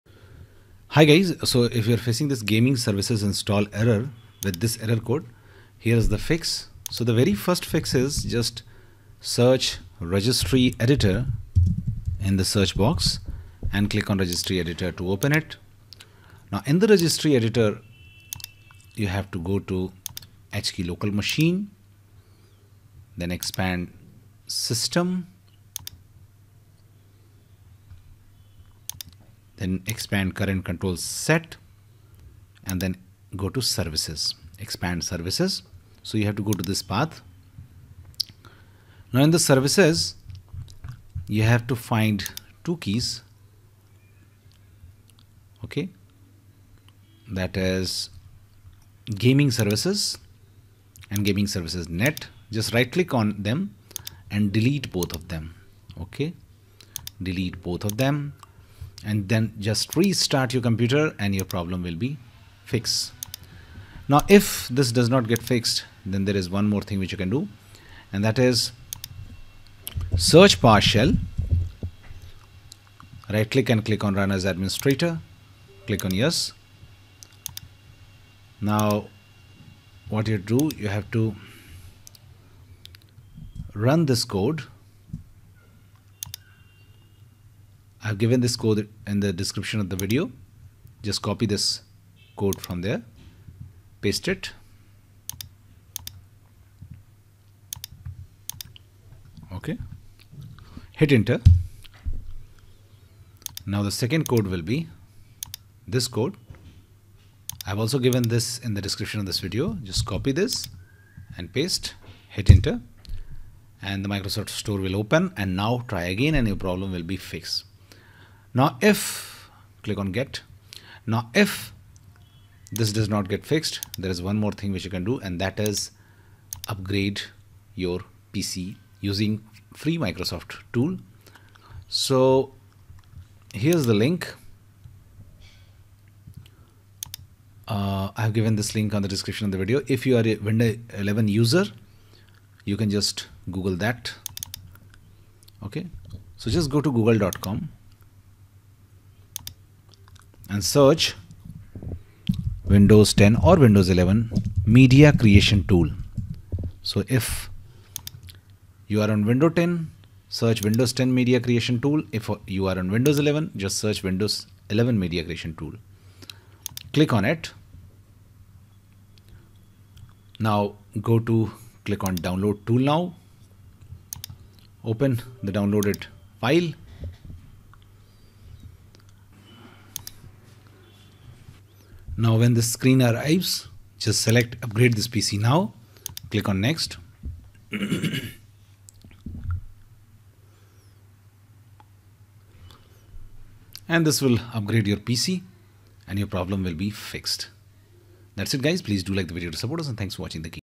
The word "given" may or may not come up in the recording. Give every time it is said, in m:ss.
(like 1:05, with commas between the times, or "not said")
1:28, 1:47, 2:18.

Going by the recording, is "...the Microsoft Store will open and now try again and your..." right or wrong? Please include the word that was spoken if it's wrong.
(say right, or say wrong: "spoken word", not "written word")
right.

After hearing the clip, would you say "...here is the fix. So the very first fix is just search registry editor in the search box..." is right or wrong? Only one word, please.
right.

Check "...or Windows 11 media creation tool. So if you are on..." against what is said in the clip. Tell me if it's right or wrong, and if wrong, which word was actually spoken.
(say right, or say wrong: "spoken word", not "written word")
right.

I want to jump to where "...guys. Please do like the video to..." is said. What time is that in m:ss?
3:18.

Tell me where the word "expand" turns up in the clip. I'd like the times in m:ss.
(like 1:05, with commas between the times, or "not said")
0:23, 0:29, 0:34.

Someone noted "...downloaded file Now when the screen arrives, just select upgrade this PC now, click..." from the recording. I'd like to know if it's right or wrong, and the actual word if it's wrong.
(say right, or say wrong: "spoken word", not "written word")
right.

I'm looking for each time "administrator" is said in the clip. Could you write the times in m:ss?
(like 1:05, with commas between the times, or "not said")
1:14.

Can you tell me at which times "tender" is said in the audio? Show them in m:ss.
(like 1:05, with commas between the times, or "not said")
not said.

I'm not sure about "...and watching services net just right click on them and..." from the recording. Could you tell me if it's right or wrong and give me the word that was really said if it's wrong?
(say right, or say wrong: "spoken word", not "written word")
wrong: "gaming", not "watching".